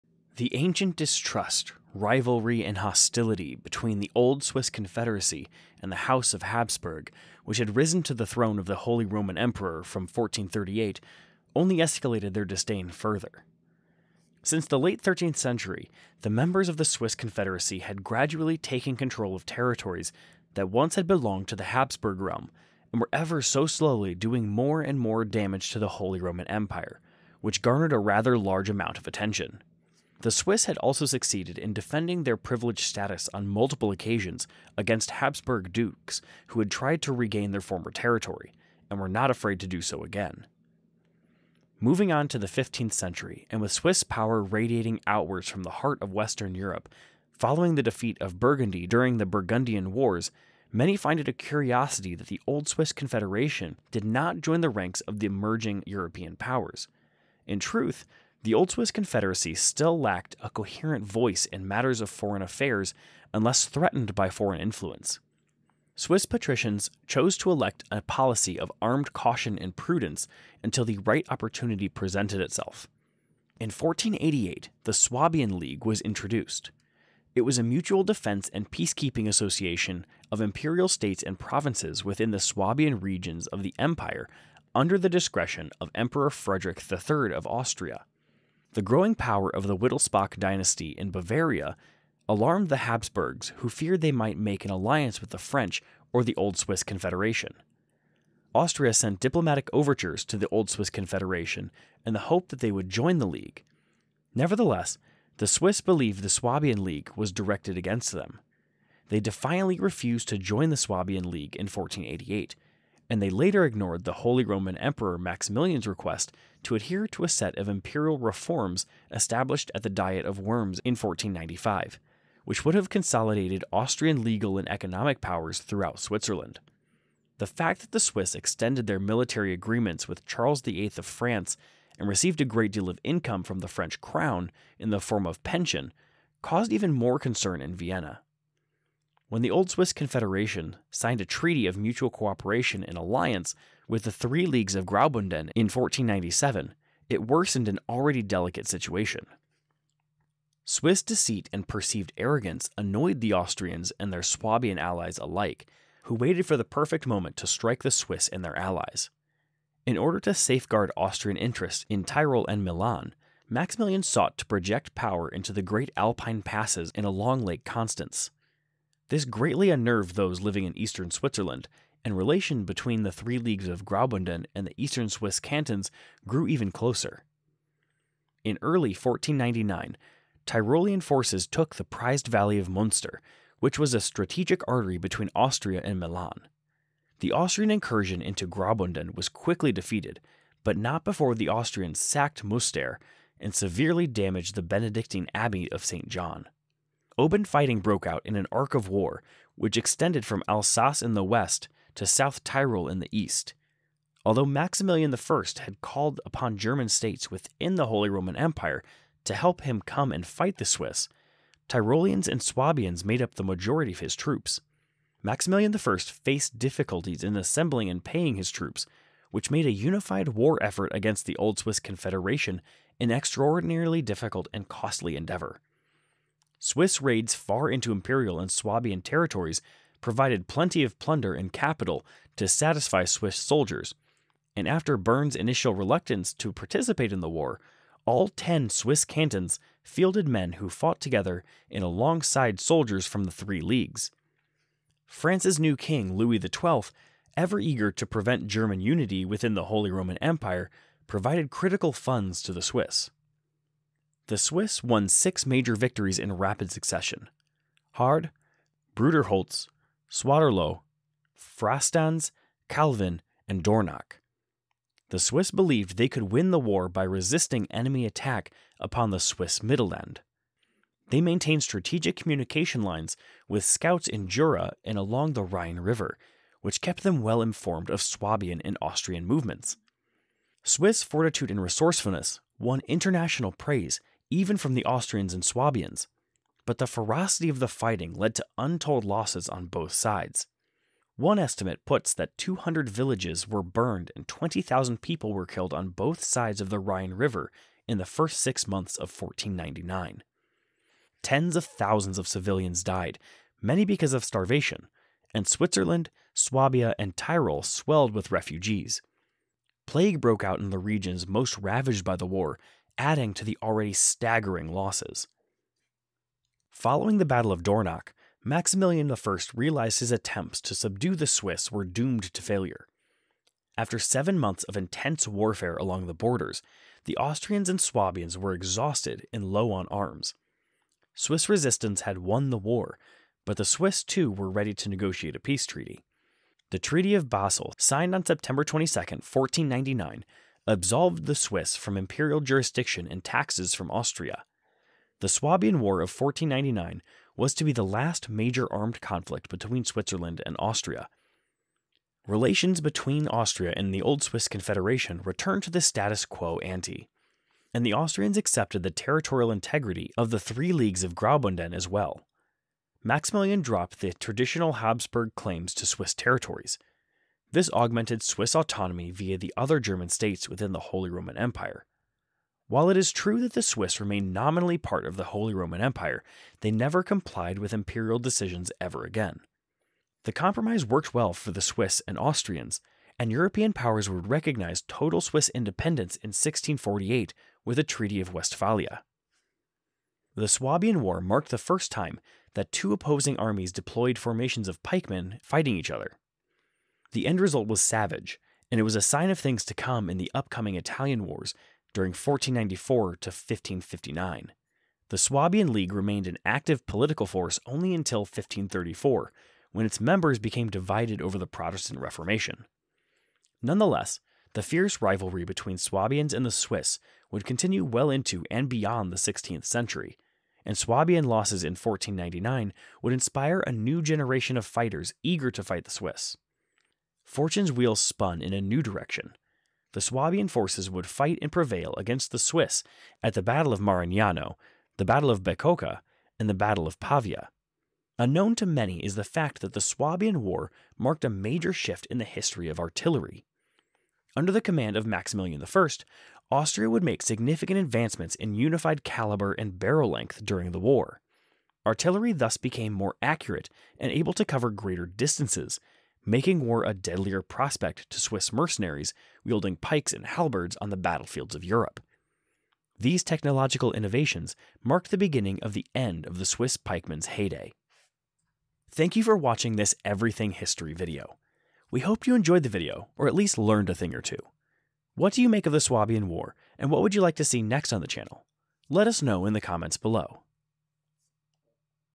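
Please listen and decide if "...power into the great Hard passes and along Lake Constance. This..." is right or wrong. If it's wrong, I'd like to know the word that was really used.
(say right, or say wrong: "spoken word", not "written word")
wrong: "Alpine", not "Hard".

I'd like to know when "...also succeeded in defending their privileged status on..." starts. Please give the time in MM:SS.
00:30.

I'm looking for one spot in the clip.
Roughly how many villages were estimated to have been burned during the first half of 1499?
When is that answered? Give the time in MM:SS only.
04:52.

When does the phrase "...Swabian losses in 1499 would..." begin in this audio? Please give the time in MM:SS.
07:00.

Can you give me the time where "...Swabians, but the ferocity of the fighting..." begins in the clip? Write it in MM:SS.
04:45.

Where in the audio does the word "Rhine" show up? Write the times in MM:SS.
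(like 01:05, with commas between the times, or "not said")
04:35, 04:56.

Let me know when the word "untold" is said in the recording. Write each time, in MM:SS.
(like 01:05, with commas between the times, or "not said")
04:48.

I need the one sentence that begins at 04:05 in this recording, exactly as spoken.
France's new king, Louis XII, ever eager to prevent German unity within the Holy Roman Empire, provided critical funds to the Swiss.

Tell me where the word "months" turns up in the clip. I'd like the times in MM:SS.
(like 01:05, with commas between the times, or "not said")
04:58, 05:24.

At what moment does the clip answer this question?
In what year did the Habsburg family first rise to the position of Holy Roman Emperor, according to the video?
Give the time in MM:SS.
00:10.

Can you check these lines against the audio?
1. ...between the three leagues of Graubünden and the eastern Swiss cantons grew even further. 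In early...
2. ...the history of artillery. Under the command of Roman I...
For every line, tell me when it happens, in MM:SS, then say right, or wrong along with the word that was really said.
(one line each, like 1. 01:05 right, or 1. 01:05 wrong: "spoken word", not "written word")
1. 02:52 wrong: "closer", not "further"
2. 07:22 wrong: "Maximilian", not "Roman".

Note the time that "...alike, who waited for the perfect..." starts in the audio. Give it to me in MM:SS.
02:35.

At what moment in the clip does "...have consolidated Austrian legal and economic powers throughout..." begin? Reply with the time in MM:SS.
02:02.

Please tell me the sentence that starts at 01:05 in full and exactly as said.
Swiss patricians chose to elect a policy of armed caution and prudence until the right opportunity presented itself.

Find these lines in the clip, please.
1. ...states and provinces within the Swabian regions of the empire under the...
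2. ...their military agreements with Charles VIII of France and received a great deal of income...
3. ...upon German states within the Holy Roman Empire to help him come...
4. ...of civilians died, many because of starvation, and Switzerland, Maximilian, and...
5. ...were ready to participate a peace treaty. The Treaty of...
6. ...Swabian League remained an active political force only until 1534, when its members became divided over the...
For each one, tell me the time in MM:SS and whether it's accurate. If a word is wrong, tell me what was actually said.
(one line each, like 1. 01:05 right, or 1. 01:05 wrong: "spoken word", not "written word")
1. 01:20 right
2. 02:08 right
3. 03:26 right
4. 05:02 wrong: "Swabia", not "Maximilian"
5. 05:34 wrong: "negotiate", not "participate"
6. 06:45 right.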